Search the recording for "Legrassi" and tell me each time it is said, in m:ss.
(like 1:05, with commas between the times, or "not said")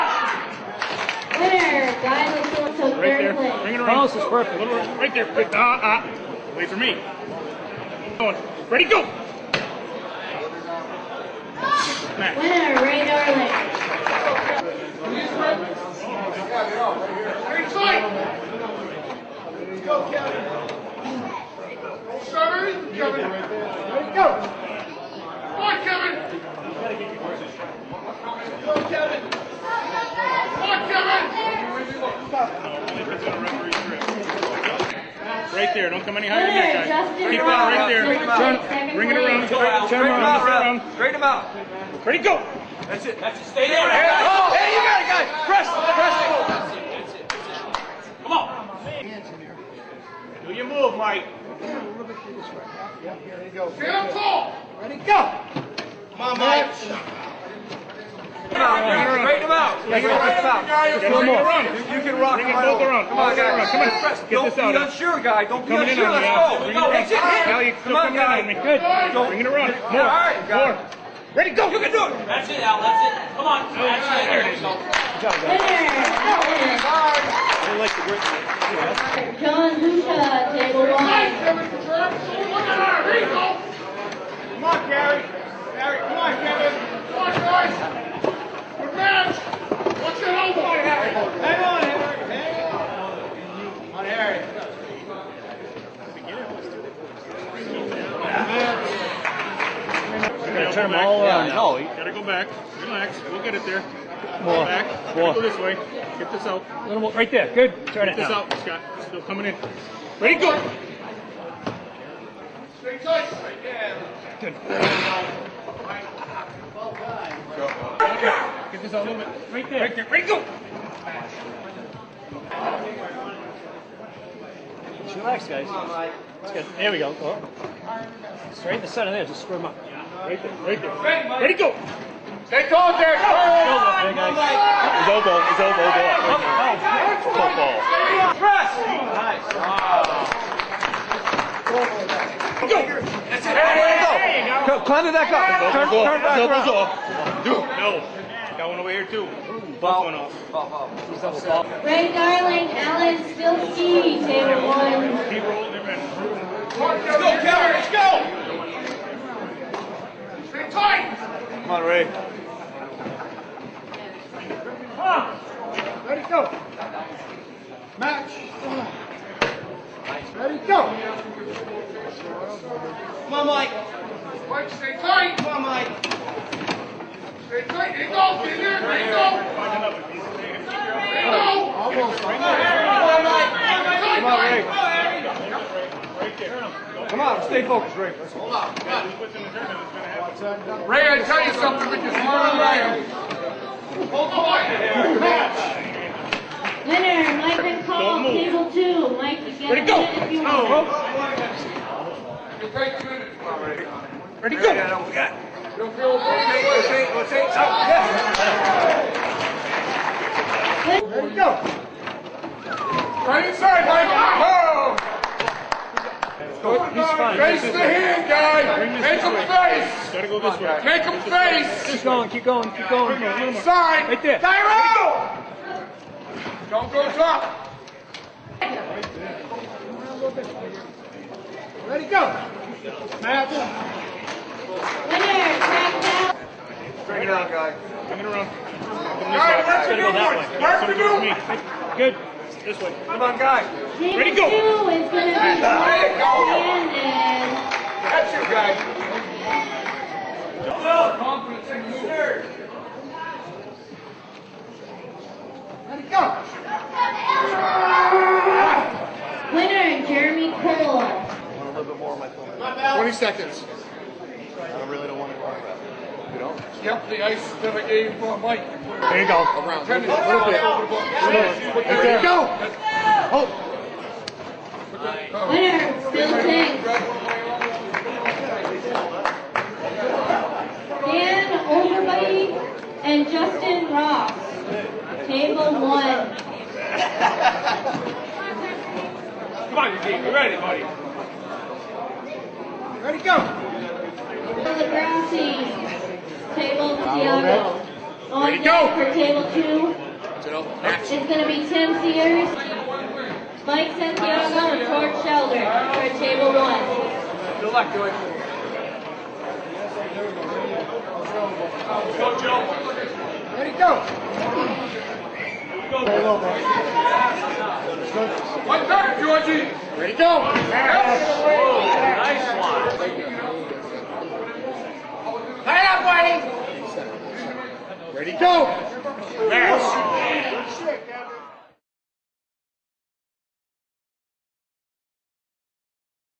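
4:54.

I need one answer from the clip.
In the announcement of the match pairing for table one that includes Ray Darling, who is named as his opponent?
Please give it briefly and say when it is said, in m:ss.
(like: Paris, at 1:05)
Alan Stilski, at 2:32.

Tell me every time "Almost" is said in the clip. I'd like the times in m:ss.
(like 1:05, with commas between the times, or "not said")
3:01.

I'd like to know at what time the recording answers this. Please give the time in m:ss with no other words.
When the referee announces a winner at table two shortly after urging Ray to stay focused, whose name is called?
3:17.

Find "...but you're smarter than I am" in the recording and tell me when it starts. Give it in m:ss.
3:11.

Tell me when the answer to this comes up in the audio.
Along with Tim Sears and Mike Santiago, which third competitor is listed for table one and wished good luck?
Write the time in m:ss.
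5:04.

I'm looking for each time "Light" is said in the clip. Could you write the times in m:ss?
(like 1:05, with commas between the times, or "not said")
5:25.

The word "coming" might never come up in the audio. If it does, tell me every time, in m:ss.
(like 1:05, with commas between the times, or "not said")
1:07, 1:49.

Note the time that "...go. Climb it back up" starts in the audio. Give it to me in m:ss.
2:24.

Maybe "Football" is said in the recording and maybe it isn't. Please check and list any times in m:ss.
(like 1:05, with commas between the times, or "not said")
2:17.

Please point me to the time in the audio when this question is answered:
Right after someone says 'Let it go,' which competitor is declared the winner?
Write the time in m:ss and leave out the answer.
4:20.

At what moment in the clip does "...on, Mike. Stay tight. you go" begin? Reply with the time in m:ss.
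2:55.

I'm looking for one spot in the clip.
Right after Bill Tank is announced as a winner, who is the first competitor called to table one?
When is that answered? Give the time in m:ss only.
4:41.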